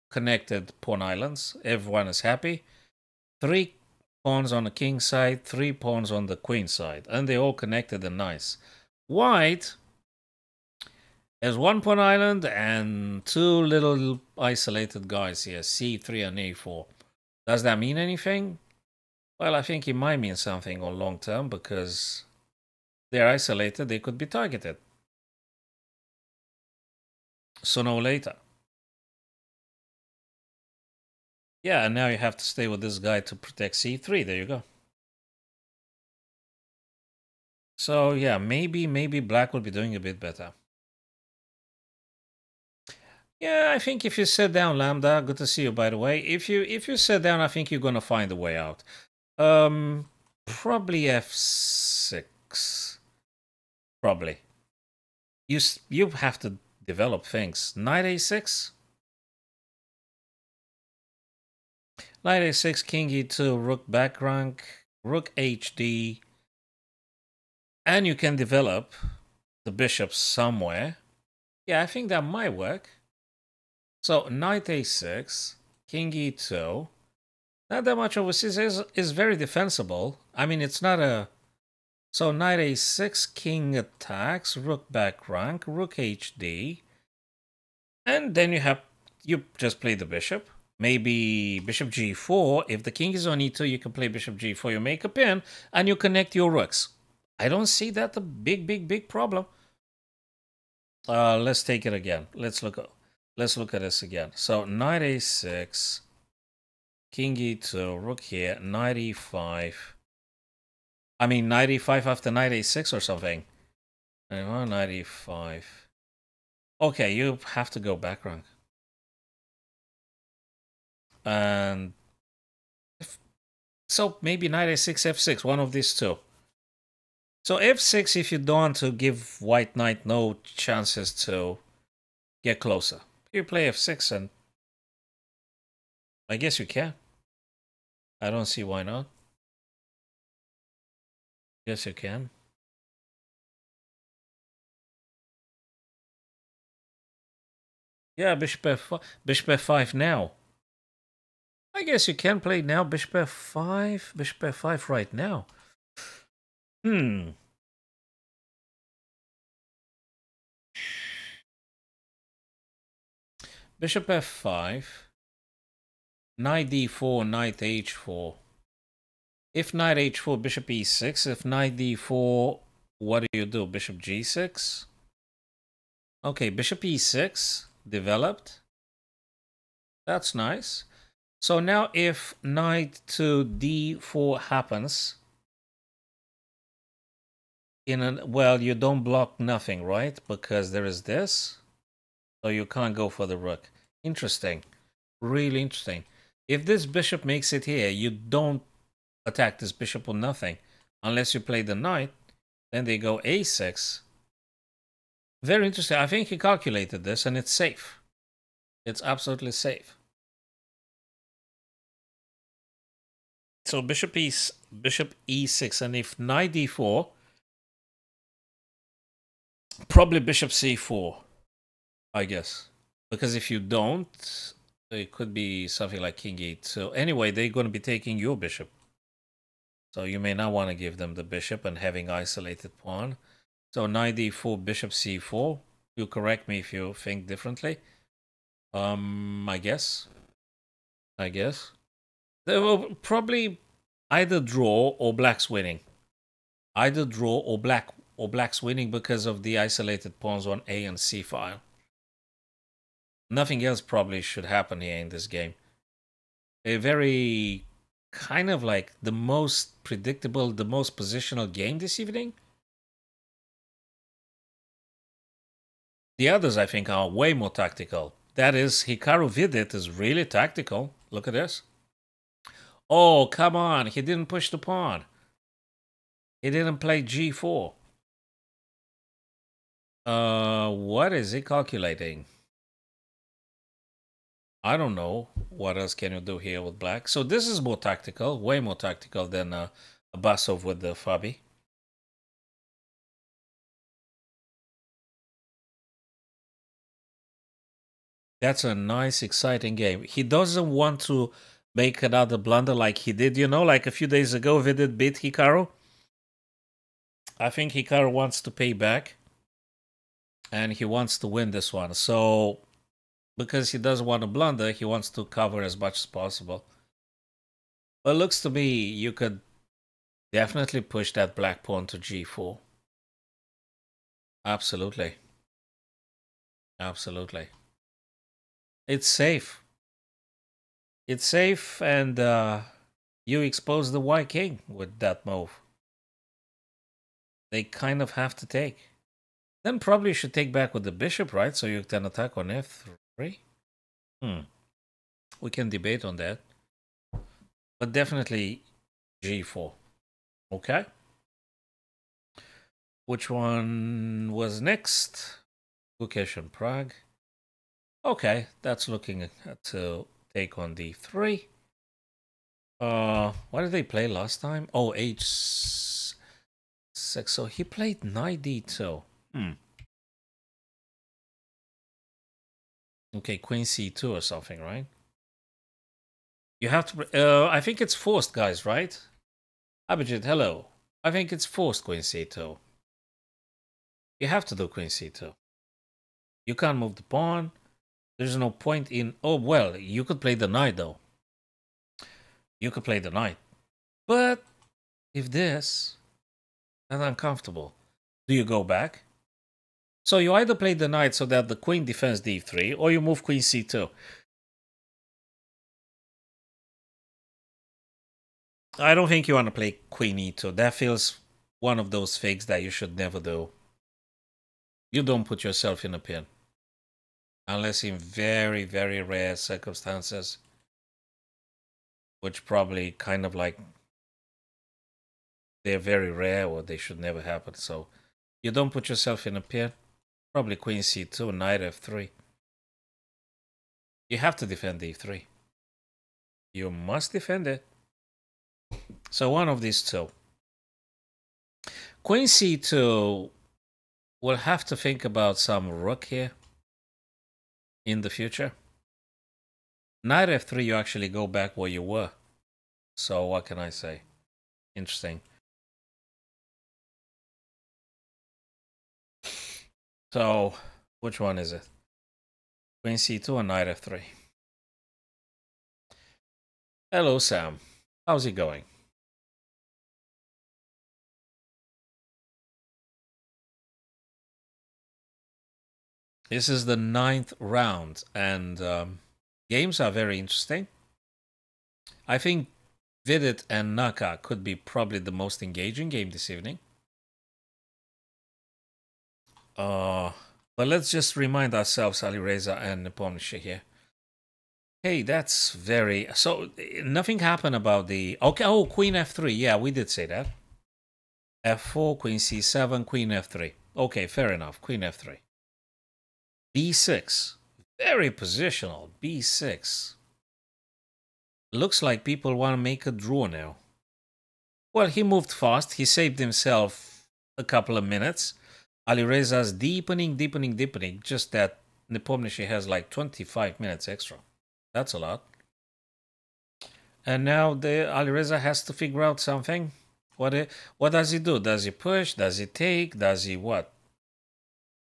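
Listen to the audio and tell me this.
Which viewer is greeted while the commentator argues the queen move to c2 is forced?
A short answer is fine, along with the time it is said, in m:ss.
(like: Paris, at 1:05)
Abhijit, at 6:19.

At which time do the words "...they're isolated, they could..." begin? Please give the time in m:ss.
0:23.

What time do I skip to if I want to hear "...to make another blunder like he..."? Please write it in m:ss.
5:01.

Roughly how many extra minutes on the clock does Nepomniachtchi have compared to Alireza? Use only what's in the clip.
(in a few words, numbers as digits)
25.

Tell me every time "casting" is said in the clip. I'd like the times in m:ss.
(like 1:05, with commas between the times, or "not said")
not said.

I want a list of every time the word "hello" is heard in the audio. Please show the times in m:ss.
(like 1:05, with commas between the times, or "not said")
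6:20, 7:46.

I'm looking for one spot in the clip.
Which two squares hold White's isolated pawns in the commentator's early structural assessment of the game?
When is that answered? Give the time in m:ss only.
0:15.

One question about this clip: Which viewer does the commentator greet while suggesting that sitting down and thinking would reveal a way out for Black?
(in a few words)
Lambda.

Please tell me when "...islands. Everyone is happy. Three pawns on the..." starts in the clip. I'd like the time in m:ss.
0:01.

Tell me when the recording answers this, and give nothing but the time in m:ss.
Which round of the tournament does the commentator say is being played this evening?
7:56.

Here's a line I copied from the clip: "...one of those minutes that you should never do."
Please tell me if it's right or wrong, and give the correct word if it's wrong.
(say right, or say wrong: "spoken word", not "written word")
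wrong: "fakes", not "minutes".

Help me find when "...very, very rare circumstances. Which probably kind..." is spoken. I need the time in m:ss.
6:57.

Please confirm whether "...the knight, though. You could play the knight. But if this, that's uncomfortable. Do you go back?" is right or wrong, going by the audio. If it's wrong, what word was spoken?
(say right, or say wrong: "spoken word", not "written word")
right.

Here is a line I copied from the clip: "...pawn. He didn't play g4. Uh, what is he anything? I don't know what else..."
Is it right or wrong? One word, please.
wrong.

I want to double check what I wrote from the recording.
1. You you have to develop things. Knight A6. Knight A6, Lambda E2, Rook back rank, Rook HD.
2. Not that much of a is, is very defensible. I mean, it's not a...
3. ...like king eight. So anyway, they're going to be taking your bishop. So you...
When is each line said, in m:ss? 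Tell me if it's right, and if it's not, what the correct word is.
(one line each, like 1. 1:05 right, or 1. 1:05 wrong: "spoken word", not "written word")
1. 0:55 wrong: "King", not "Lambda"
2. 1:17 right
3. 3:46 right.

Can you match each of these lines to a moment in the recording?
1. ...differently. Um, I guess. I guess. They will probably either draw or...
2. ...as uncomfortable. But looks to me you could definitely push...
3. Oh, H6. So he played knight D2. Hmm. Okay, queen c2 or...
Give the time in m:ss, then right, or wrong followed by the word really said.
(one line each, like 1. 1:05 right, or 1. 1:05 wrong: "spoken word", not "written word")
1. 3:57 right
2. 5:15 wrong: "possible", not "uncomfortable"
3. 6:04 right.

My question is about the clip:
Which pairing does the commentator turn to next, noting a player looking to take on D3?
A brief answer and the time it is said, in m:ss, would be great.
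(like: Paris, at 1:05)
Gukesh and Pragg, at 5:56.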